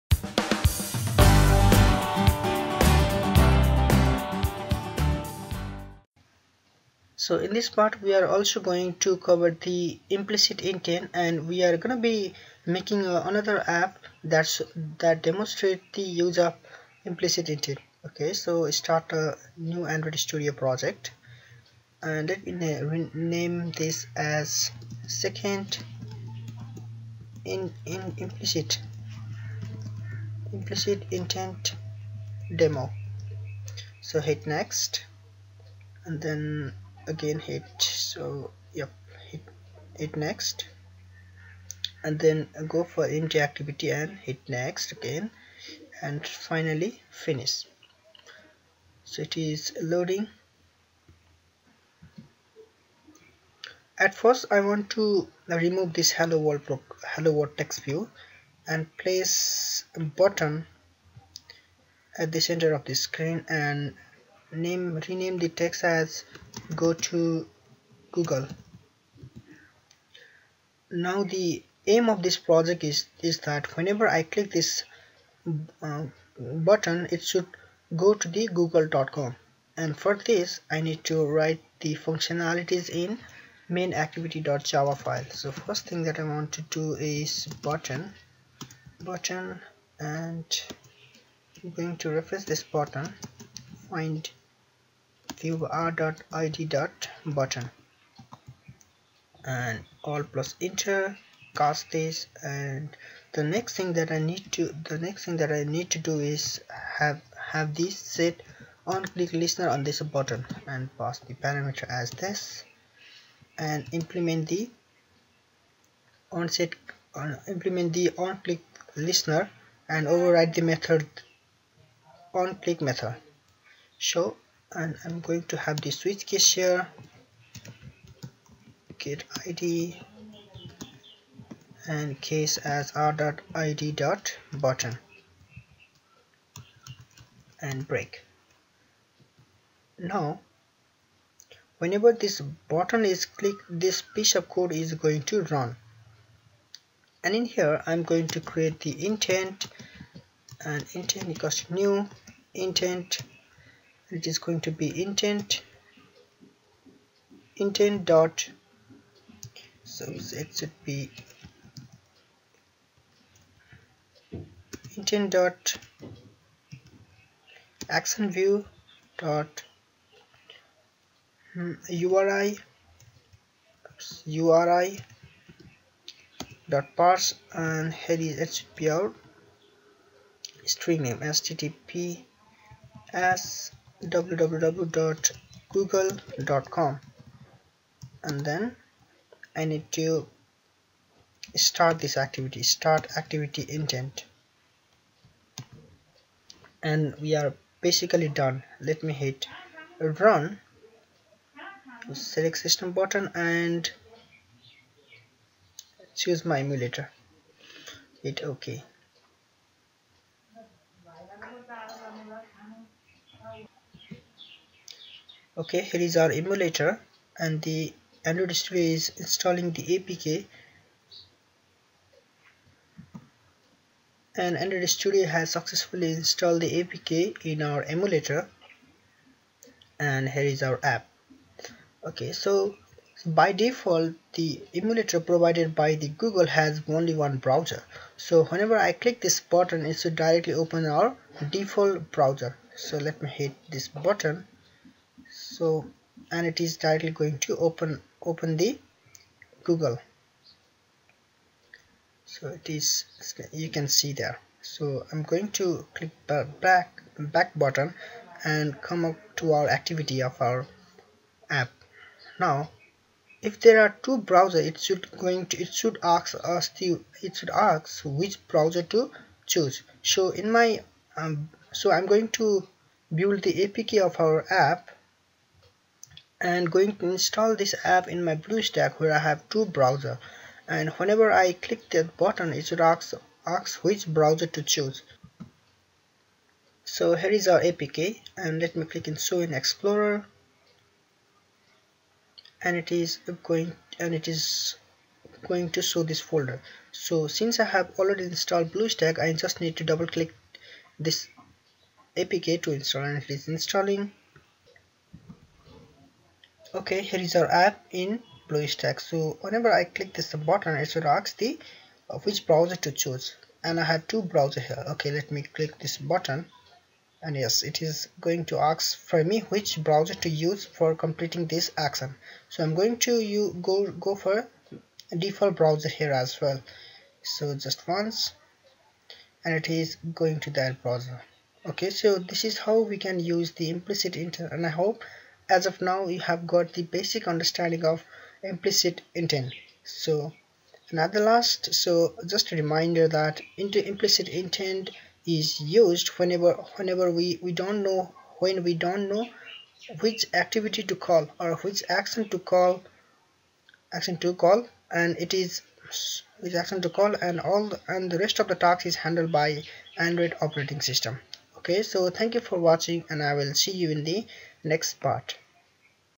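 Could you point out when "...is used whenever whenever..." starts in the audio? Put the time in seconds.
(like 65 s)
345 s.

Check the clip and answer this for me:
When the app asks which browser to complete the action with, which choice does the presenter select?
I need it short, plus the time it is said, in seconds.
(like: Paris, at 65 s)
Just once, at 327 s.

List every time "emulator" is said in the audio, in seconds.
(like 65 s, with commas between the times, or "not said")
206 s, 216 s, 227 s, 234 s.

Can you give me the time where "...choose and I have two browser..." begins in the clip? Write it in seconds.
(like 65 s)
312 s.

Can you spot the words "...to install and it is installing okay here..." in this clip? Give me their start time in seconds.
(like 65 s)
302 s.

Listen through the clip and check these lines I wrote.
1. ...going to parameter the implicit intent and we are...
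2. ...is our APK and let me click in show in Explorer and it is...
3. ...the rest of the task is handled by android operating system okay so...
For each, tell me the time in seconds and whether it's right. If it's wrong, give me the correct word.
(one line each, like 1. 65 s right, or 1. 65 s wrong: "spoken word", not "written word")
1. 8 s wrong: "cover", not "parameter"
2. 287 s right
3. 358 s right.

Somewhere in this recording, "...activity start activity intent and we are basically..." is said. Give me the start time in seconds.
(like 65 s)
192 s.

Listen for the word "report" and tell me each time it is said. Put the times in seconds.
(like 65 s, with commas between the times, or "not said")
not said.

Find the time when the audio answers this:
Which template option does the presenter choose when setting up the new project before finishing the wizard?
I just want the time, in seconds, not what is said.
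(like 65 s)
43 s.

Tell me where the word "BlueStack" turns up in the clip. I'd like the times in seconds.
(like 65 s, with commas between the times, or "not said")
278 s, 298 s, 308 s.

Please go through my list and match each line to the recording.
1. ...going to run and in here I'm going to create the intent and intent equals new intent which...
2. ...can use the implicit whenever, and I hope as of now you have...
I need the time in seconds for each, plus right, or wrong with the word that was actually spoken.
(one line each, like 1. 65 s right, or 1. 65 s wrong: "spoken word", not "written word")
1. 144 s right
2. 332 s wrong: "inter", not "whenever".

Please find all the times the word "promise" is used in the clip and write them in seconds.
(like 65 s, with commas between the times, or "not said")
not said.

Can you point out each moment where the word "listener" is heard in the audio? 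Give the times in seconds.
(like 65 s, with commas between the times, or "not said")
109 s, 118 s.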